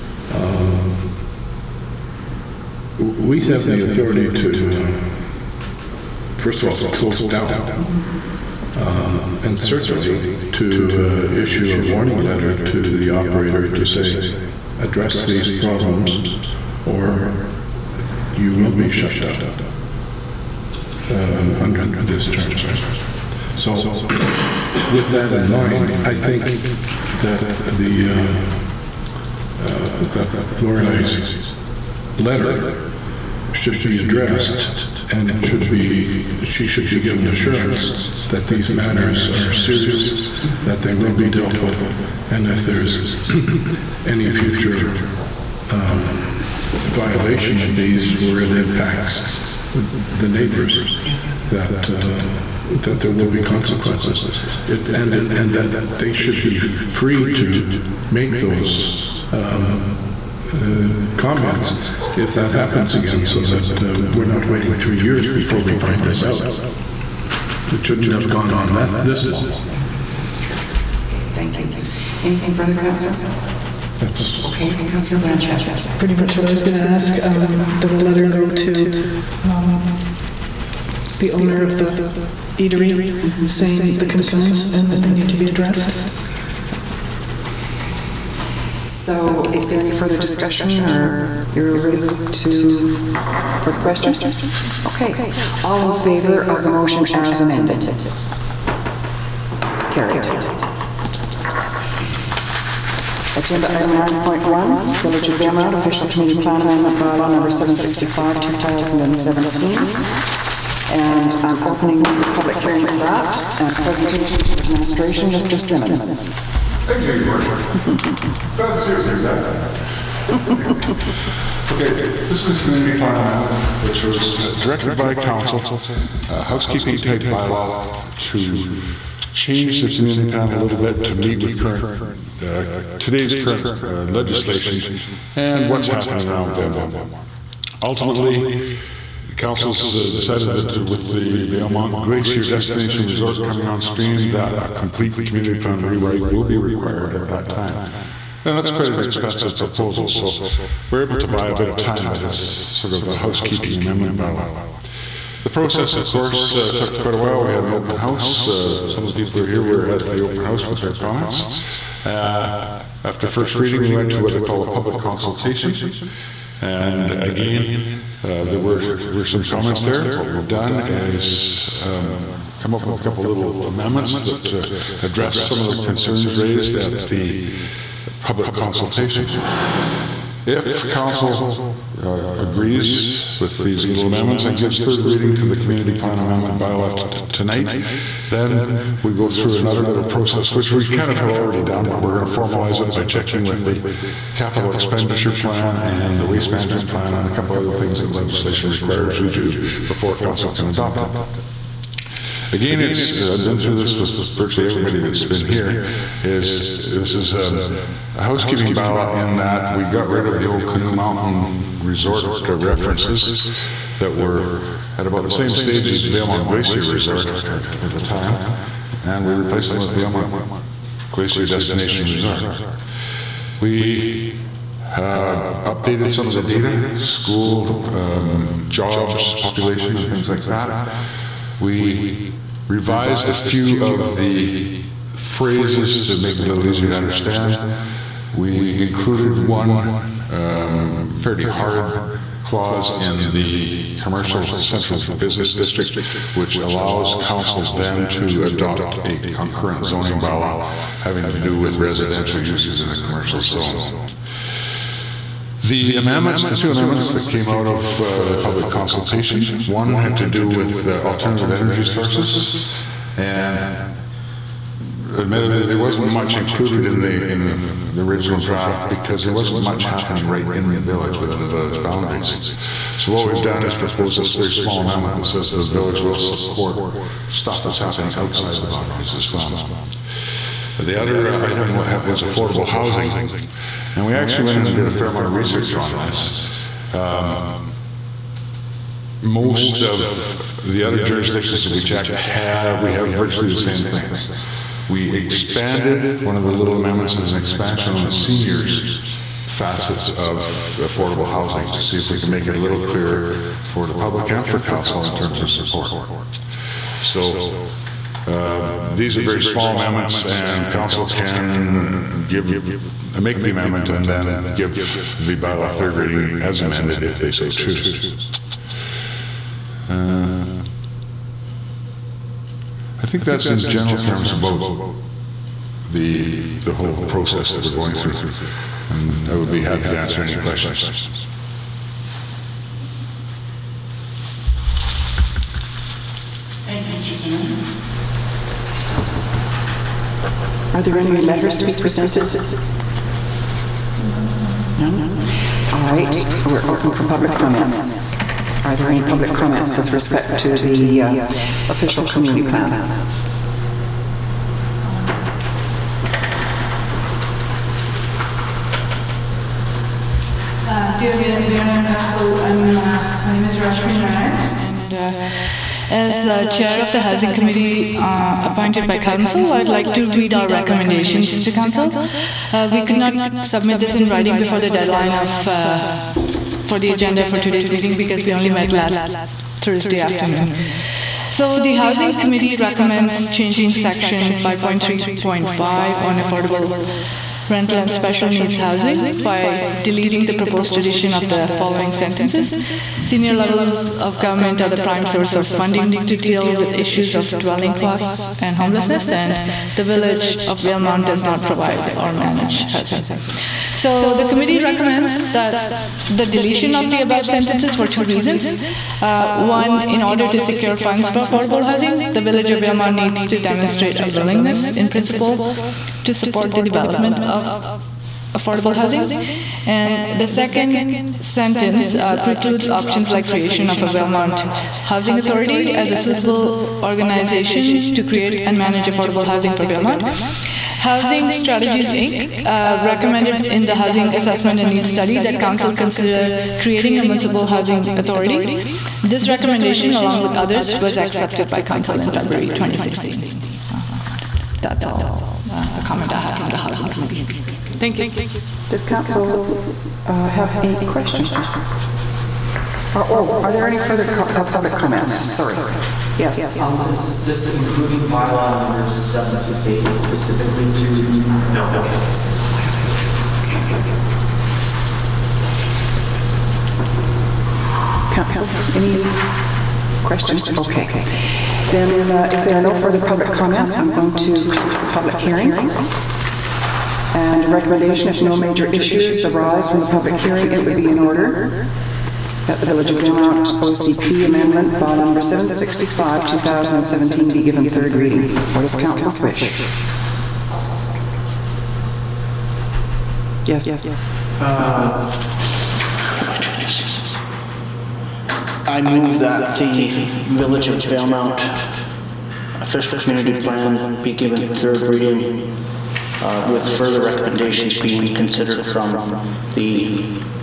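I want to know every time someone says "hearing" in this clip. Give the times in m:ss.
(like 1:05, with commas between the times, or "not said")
1:52, 7:55, 8:00.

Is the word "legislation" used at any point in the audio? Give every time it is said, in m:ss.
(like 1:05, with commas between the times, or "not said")
2:14, 3:18.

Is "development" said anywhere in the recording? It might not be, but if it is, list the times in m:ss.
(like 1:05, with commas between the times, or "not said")
6:56.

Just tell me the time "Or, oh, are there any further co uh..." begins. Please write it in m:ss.
7:32.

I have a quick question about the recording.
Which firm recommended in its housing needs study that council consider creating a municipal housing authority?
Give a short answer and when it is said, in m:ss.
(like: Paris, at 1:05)
Housing Strategies Inc., at 7:10.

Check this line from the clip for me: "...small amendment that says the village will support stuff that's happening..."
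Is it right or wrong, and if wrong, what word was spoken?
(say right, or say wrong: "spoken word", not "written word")
right.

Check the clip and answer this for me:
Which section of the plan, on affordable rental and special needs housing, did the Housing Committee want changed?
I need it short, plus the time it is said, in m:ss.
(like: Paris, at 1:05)
5.3.5, at 6:24.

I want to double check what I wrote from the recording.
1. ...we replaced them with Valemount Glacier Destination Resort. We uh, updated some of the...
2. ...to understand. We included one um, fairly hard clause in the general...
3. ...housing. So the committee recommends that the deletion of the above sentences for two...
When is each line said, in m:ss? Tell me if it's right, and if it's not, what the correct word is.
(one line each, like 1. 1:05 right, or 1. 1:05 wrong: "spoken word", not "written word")
1. 3:39 right
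2. 3:56 wrong: "commercial", not "general"
3. 6:42 right.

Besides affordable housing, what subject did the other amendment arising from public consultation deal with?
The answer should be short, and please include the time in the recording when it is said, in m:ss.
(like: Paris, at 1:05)
alternative energy sources, at 4:21.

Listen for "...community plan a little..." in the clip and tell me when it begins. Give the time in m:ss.
2:09.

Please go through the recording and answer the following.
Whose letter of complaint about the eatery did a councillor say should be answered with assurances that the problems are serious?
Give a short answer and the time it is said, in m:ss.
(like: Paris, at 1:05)
Lorelei, at 0:30.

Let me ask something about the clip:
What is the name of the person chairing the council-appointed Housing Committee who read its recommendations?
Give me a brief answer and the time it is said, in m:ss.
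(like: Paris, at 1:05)
Rashmi Narayan, at 6:03.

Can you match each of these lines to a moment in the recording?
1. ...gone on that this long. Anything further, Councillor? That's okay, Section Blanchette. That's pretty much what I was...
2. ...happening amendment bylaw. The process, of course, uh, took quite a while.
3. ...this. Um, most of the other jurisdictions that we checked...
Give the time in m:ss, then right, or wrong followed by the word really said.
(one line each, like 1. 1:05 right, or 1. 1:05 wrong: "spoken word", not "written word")
1. 1:08 wrong: "Councillor", not "Section"
2. 2:33 wrong: "housekeeping", not "happening"
3. 4:45 right.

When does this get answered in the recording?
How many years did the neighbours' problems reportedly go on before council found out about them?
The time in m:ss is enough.
1:04.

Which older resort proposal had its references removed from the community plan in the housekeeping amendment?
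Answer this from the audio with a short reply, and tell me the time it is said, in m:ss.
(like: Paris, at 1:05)
Canoe Mountain Resort, at 3:30.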